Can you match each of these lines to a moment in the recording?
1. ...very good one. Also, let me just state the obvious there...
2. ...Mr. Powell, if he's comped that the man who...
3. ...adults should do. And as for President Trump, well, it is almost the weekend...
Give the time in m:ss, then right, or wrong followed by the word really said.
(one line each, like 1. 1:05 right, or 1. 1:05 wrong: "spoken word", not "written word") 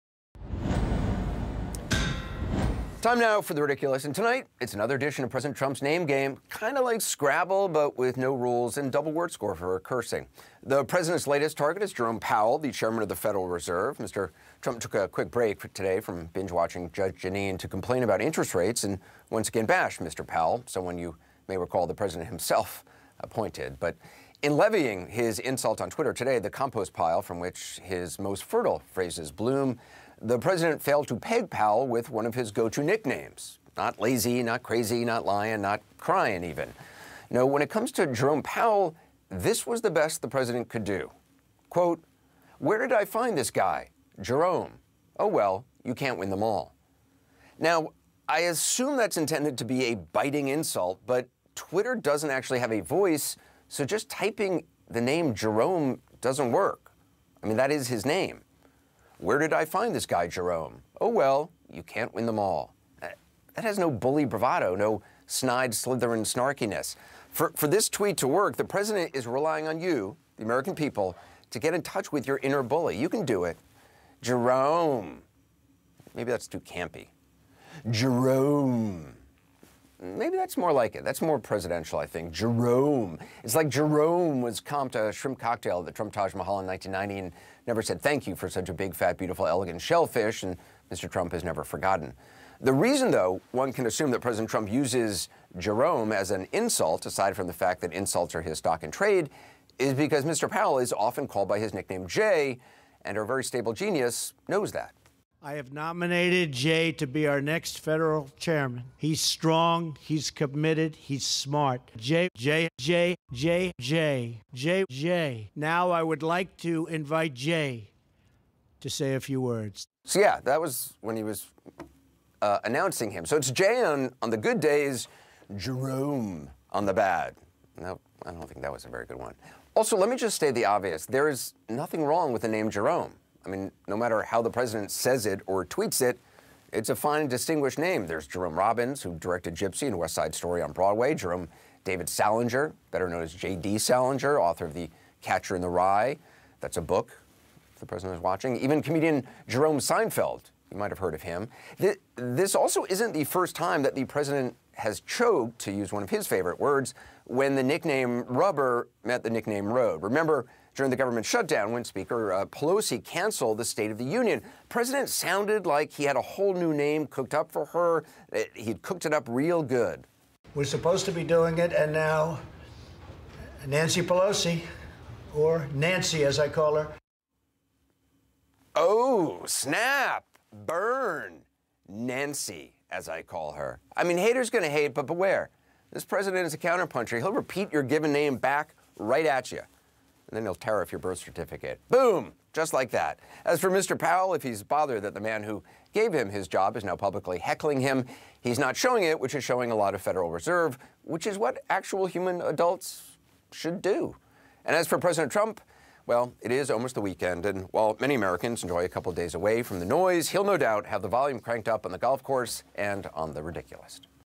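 1. 2:08 right
2. 3:13 wrong: "bothered", not "comped"
3. 3:22 right.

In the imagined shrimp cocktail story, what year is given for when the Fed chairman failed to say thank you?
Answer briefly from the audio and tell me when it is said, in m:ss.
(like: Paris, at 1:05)
1990, at 1:26.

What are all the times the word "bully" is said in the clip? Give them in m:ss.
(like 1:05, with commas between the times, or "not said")
1:03, 1:12.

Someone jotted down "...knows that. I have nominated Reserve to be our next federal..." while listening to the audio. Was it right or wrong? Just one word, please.
wrong.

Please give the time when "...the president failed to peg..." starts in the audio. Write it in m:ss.
0:30.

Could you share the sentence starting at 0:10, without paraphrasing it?
The president's latest target is Jerome Powell, the chairman of the Federal Reserve.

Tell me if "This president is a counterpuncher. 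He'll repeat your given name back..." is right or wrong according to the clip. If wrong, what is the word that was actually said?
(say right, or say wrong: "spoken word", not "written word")
right.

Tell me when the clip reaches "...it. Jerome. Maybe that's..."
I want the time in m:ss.
1:13.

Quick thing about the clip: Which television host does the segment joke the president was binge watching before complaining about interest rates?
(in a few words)
Judge Jeanine.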